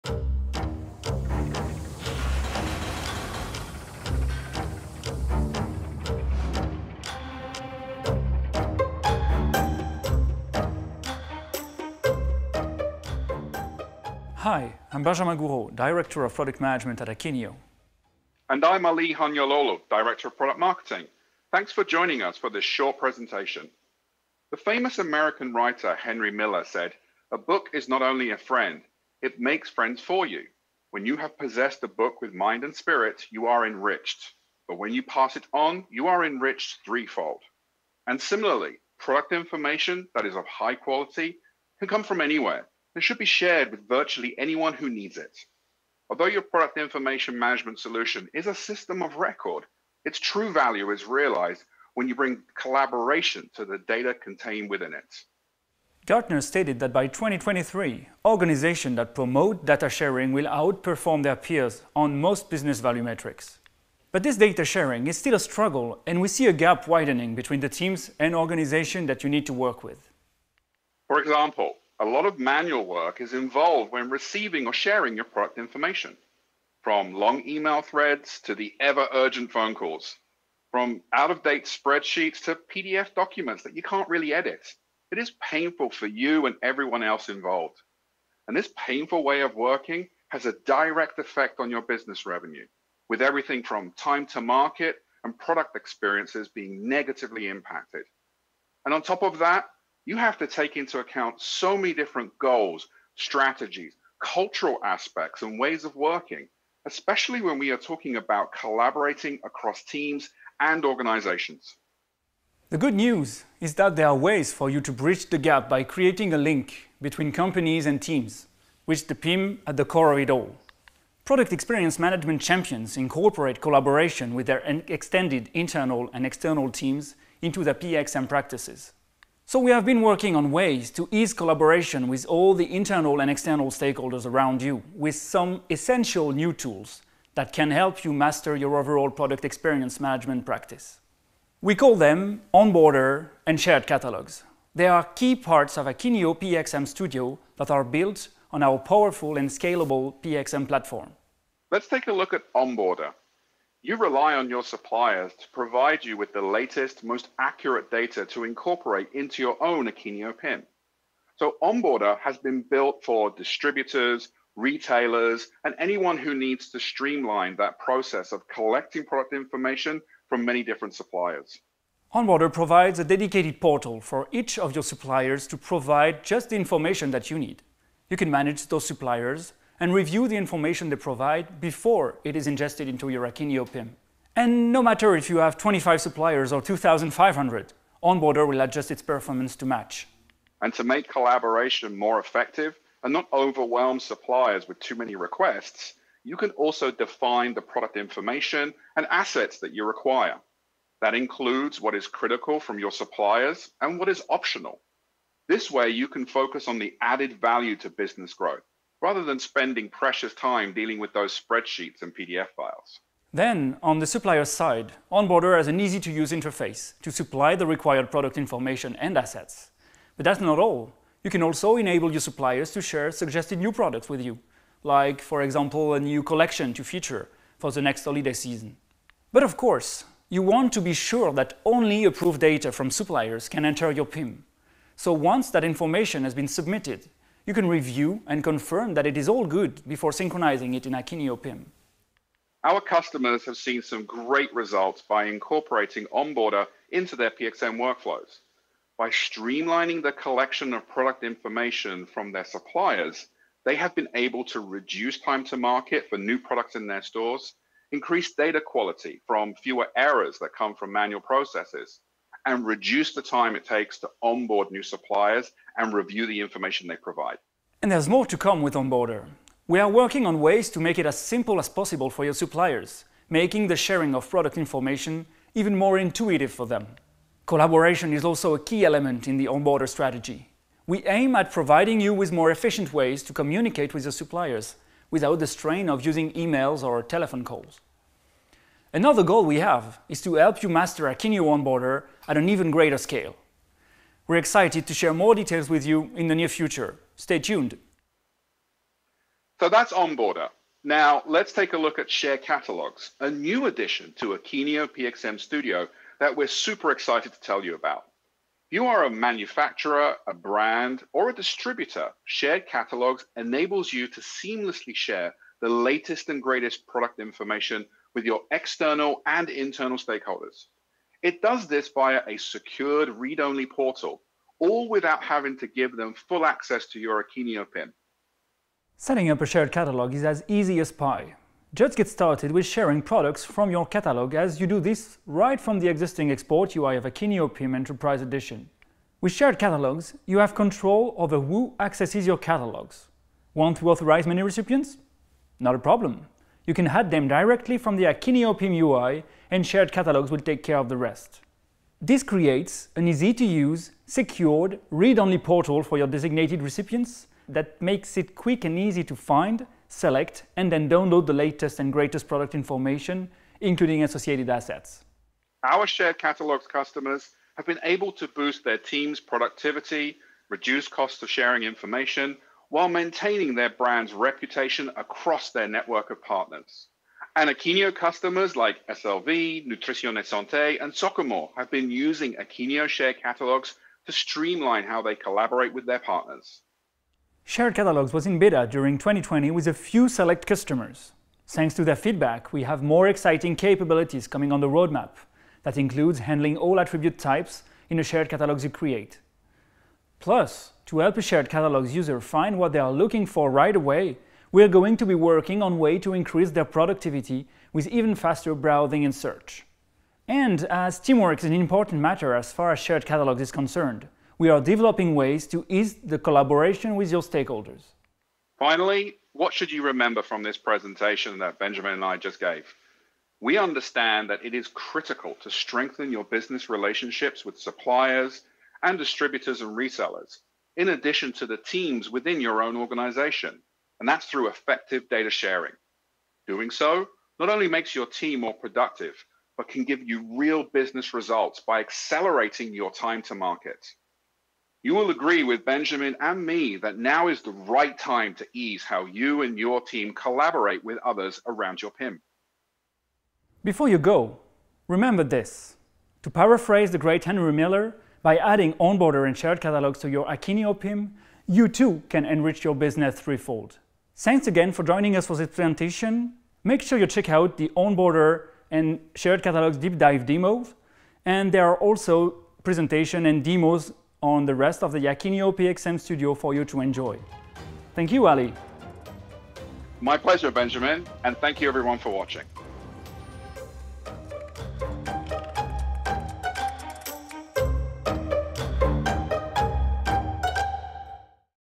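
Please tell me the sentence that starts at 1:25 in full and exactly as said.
It is painful for you and everyone else involved.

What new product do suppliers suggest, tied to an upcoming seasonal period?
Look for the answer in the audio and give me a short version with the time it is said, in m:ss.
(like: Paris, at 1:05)
a new collection, at 3:45.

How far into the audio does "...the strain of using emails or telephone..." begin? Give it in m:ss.
4:45.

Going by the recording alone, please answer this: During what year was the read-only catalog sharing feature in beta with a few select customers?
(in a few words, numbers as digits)
2020.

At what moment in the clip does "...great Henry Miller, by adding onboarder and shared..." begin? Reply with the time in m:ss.
7:36.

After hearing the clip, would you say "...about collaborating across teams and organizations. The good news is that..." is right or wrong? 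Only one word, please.
right.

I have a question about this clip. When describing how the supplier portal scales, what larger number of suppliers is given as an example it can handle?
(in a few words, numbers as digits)
2,500.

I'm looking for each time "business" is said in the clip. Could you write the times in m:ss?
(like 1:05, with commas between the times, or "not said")
1:02, 1:31, 3:27, 7:06, 7:20, 7:42.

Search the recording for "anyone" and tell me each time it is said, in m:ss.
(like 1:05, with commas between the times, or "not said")
0:44, 2:45.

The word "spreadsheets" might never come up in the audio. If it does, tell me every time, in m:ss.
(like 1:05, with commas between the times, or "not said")
1:21, 3:31.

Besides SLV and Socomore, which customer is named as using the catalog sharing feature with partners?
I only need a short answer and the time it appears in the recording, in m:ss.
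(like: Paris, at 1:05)
Nutrition et Santé, at 6:19.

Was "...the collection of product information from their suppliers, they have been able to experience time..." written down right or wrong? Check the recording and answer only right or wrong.
wrong.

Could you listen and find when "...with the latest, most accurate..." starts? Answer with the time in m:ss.
2:36.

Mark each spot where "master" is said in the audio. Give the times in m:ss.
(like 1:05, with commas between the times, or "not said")
2:18, 4:50.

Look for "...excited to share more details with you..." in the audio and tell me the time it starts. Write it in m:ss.
4:54.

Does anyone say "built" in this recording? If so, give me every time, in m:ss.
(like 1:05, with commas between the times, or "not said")
2:27, 2:42.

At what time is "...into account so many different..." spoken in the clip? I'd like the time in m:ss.
1:40.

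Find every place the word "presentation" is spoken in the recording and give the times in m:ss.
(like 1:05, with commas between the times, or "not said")
0:22, 7:00, 7:45, 7:52.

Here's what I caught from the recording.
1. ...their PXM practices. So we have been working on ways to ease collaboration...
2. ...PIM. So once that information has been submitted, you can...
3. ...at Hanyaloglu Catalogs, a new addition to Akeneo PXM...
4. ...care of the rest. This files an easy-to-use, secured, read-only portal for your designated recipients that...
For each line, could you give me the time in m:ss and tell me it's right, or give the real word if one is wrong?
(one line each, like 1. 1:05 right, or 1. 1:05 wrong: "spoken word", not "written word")
1. 2:07 right
2. 3:54 right
3. 5:01 wrong: "Share", not "Hanyaloglu"
4. 5:50 wrong: "creates", not "files".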